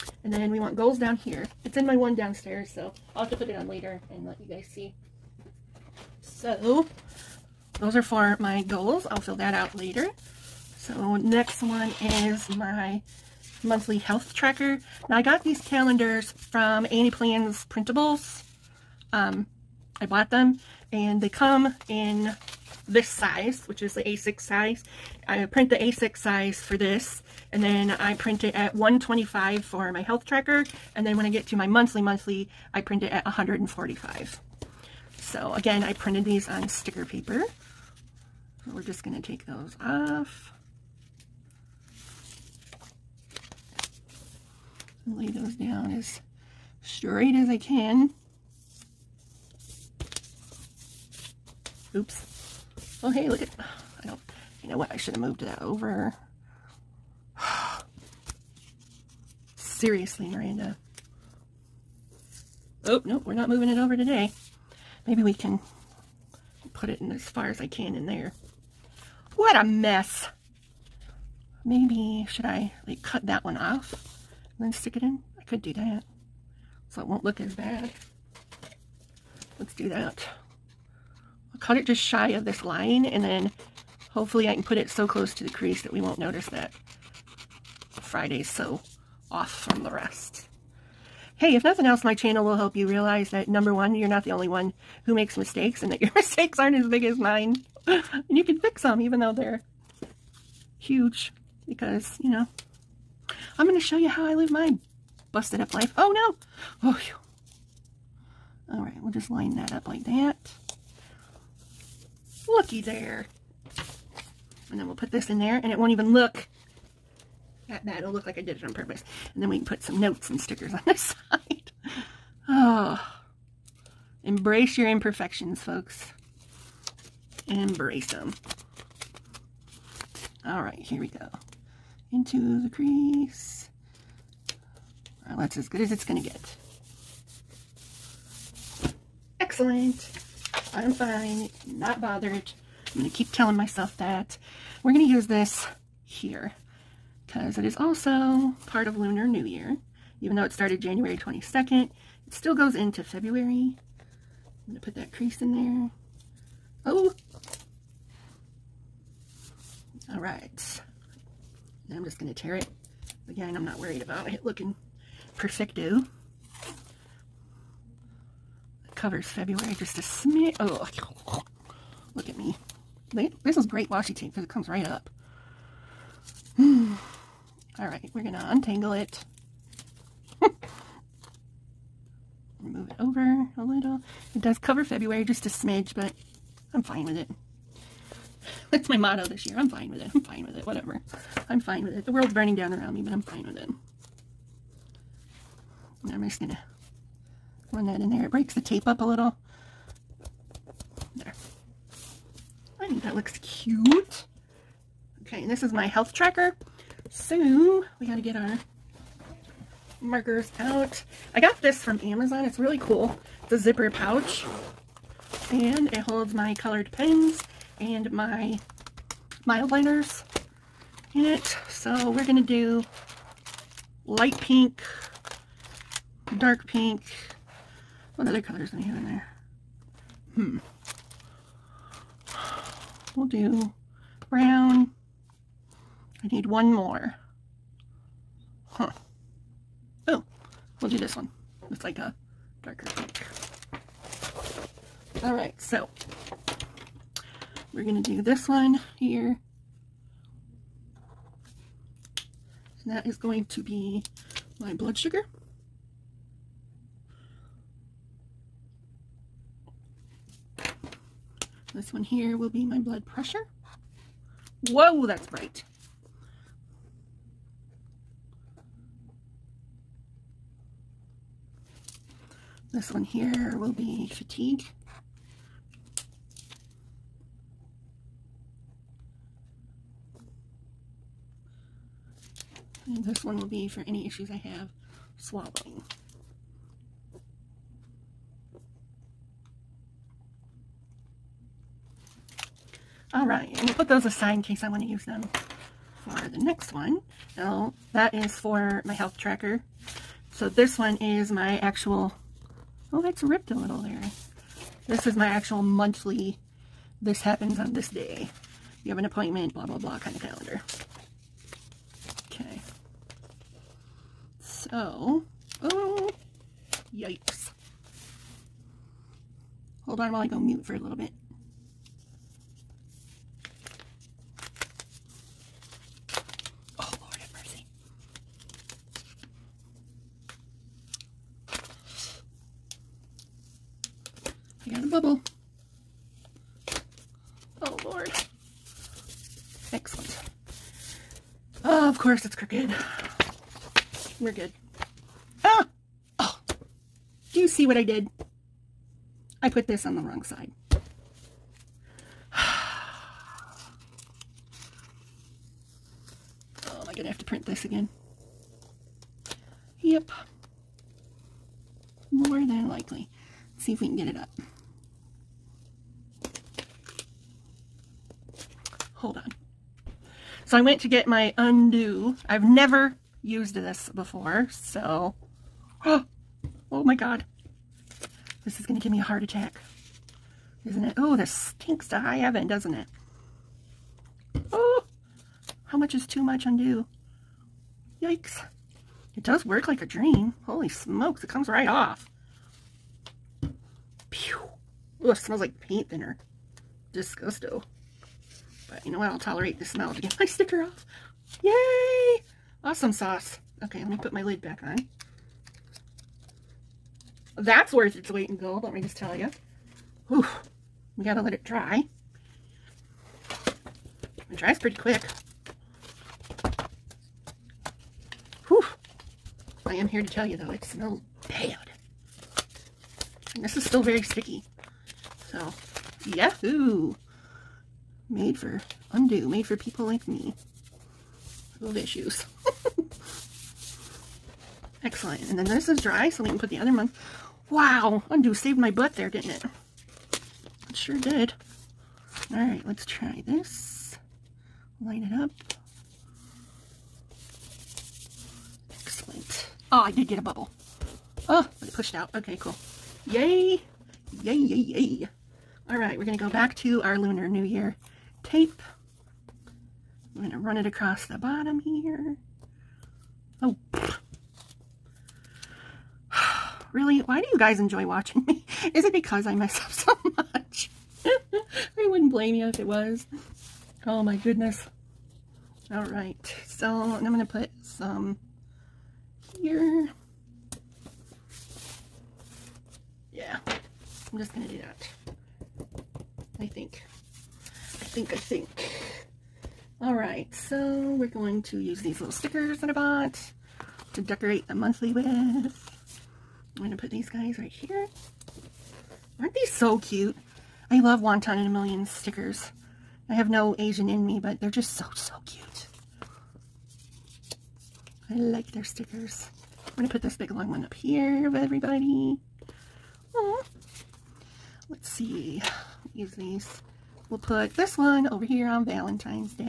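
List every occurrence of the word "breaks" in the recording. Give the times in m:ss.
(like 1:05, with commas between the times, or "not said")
3:18.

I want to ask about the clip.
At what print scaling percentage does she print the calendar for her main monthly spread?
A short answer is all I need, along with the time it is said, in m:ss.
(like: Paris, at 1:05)
145, at 0:33.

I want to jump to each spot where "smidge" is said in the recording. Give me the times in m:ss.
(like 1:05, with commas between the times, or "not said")
2:49, 3:05.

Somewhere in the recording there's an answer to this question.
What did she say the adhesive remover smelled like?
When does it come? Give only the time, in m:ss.
6:35.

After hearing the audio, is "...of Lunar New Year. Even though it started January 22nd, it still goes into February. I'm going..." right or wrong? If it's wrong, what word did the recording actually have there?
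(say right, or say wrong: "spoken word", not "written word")
right.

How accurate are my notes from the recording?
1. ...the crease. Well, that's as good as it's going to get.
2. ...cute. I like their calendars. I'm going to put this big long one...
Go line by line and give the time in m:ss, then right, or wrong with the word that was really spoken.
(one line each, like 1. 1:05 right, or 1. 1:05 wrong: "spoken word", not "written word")
1. 2:12 right
2. 8:25 wrong: "stickers", not "calendars".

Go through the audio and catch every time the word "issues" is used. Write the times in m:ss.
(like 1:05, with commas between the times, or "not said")
4:44, 7:11.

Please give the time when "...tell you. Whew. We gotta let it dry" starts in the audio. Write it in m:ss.
6:48.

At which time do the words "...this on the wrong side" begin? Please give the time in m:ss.
5:49.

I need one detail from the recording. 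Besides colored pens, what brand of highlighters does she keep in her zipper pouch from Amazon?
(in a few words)
Mildliners.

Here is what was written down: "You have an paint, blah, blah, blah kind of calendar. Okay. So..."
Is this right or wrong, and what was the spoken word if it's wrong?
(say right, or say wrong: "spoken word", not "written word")
wrong: "appointment", not "paint".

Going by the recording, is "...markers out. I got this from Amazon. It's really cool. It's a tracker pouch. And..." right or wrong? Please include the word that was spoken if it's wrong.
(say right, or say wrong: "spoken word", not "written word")
wrong: "zipper", not "tracker".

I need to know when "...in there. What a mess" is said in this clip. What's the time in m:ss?
1:07.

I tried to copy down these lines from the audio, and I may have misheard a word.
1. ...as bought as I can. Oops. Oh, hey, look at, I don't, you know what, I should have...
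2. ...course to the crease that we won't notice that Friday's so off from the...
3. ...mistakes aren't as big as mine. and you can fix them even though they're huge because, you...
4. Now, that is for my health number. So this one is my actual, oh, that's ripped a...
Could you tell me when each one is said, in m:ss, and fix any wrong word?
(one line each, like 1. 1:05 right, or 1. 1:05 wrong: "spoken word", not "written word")
1. 0:45 wrong: "straight", not "bought"
2. 1:25 wrong: "close", not "course"
3. 1:36 right
4. 4:57 wrong: "tracker", not "number".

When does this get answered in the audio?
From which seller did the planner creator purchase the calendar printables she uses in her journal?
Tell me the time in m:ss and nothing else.
0:16.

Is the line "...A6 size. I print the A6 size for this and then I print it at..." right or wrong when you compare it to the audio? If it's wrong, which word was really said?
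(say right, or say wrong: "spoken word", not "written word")
right.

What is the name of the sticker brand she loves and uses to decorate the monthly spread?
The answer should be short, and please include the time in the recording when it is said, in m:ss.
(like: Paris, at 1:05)
Wonton in a Million, at 8:20.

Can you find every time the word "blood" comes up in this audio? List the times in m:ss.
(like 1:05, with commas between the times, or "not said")
4:14, 4:22.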